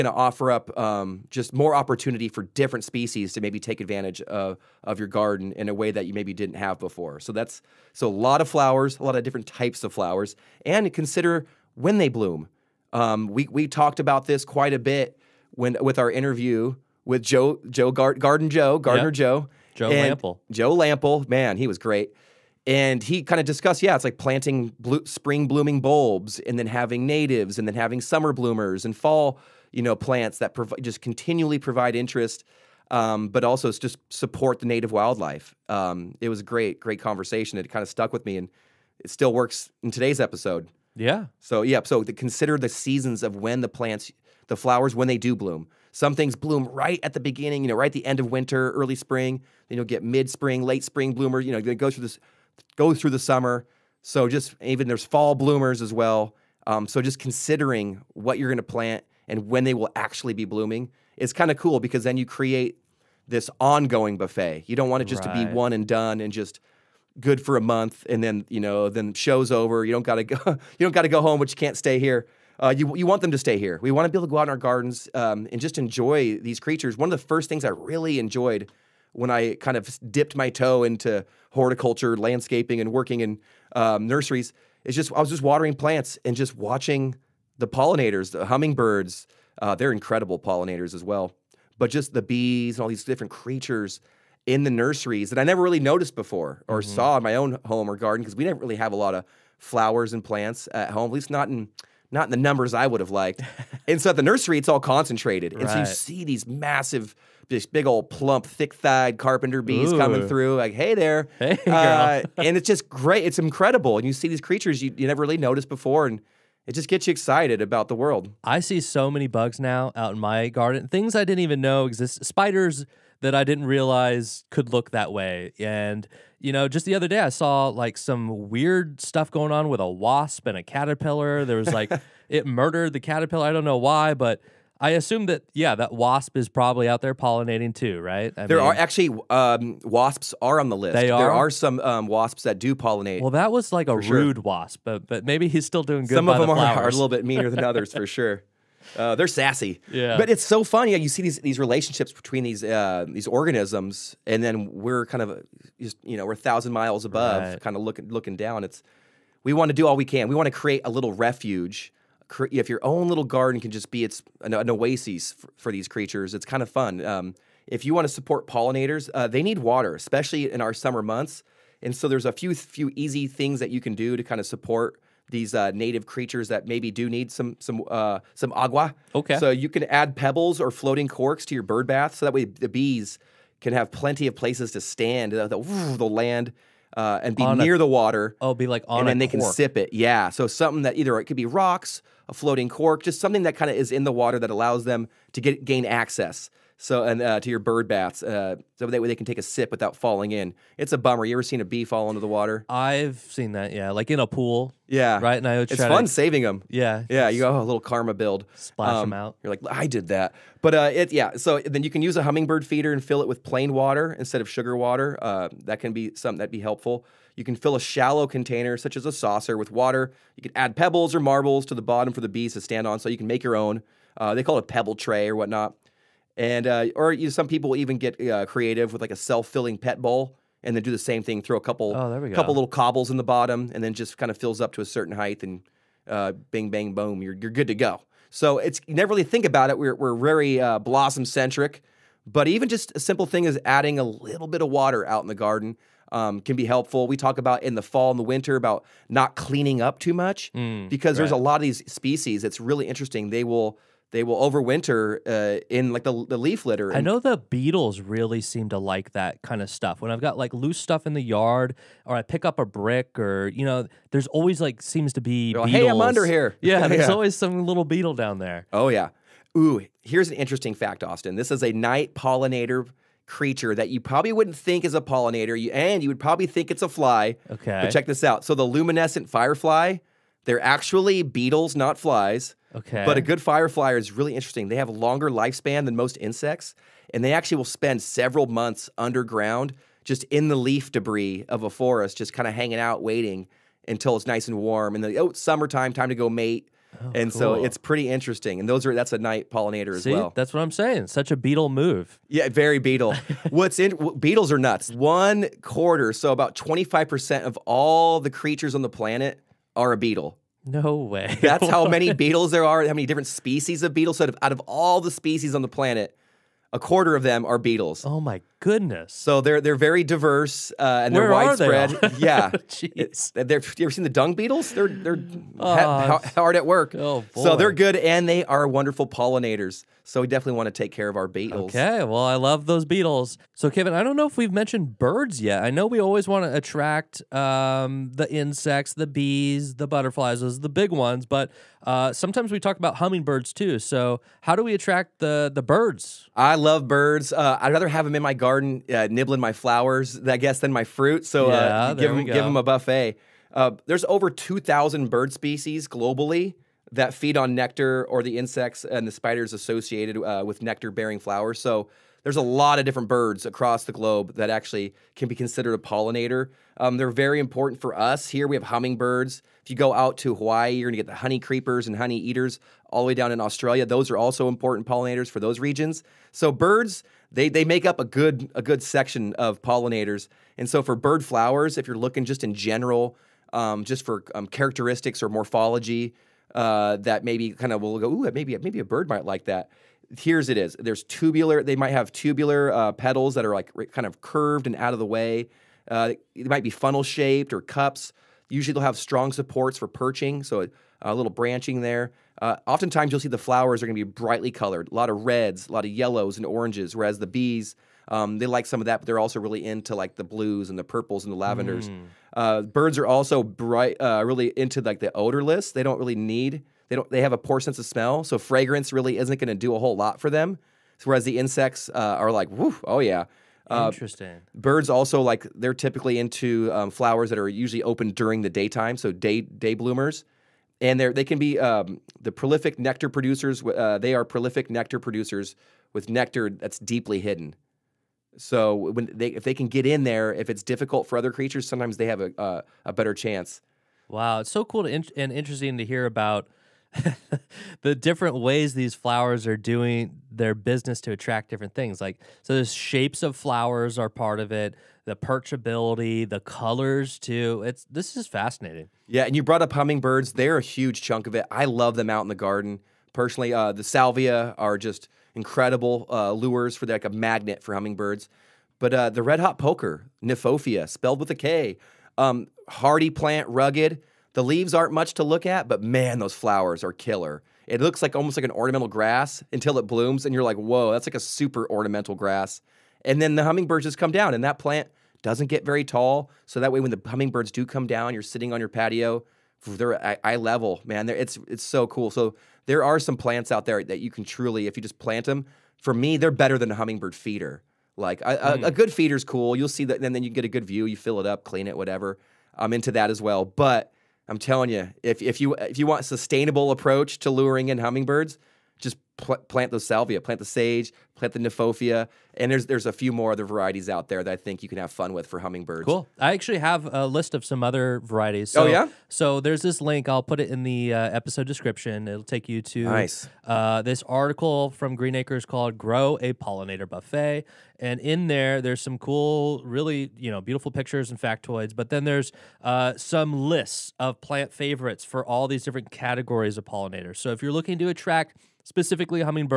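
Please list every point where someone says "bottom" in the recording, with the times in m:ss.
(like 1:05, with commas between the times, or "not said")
3:41, 3:53.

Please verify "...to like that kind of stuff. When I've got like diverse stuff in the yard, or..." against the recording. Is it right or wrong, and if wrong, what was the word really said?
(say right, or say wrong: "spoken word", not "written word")
wrong: "loose", not "diverse".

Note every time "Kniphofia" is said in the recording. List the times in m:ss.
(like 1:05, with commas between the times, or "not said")
7:50, 8:31.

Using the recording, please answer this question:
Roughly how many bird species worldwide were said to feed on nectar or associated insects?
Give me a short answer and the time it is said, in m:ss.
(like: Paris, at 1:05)
Over 2,000, at 5:54.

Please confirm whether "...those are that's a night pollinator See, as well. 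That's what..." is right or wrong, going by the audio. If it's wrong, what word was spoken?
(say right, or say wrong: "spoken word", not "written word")
right.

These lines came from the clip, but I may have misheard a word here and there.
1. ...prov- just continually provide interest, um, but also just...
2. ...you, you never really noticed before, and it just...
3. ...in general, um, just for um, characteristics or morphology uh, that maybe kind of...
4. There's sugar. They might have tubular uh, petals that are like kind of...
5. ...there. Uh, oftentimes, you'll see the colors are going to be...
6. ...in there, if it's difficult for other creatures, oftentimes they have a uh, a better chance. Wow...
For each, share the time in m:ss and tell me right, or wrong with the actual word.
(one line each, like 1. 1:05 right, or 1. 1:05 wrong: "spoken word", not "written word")
1. 0:30 right
2. 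1:54 right
3. 6:22 right
4. 6:30 wrong: "tubular", not "sugar"
5. 6:41 wrong: "flowers", not "colors"
6. 7:19 wrong: "sometimes", not "oftentimes".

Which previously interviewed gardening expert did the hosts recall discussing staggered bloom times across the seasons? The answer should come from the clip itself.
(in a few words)
Joe Lamp'l.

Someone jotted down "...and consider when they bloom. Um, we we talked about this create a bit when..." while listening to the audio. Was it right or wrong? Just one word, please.
wrong.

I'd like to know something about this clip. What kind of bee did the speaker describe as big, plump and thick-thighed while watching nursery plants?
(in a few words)
Carpenter bees.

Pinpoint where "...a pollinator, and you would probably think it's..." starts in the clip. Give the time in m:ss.
4:34.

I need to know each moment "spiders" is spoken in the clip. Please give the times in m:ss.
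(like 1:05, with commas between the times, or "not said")
2:02, 5:59.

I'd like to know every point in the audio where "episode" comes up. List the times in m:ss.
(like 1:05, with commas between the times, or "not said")
0:40, 8:41.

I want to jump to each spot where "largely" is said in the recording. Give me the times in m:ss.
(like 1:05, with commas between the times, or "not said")
not said.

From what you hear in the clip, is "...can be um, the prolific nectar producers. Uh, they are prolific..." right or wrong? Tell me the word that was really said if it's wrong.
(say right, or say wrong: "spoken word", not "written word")
right.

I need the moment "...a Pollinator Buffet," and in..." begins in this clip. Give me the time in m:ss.
8:46.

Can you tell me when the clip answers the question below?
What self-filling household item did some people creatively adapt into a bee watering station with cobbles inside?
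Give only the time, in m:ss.
3:49.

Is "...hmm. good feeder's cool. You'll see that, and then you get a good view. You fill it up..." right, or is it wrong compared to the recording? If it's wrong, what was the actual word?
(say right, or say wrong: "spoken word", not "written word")
right.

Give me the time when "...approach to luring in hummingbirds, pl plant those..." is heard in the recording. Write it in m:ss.
8:26.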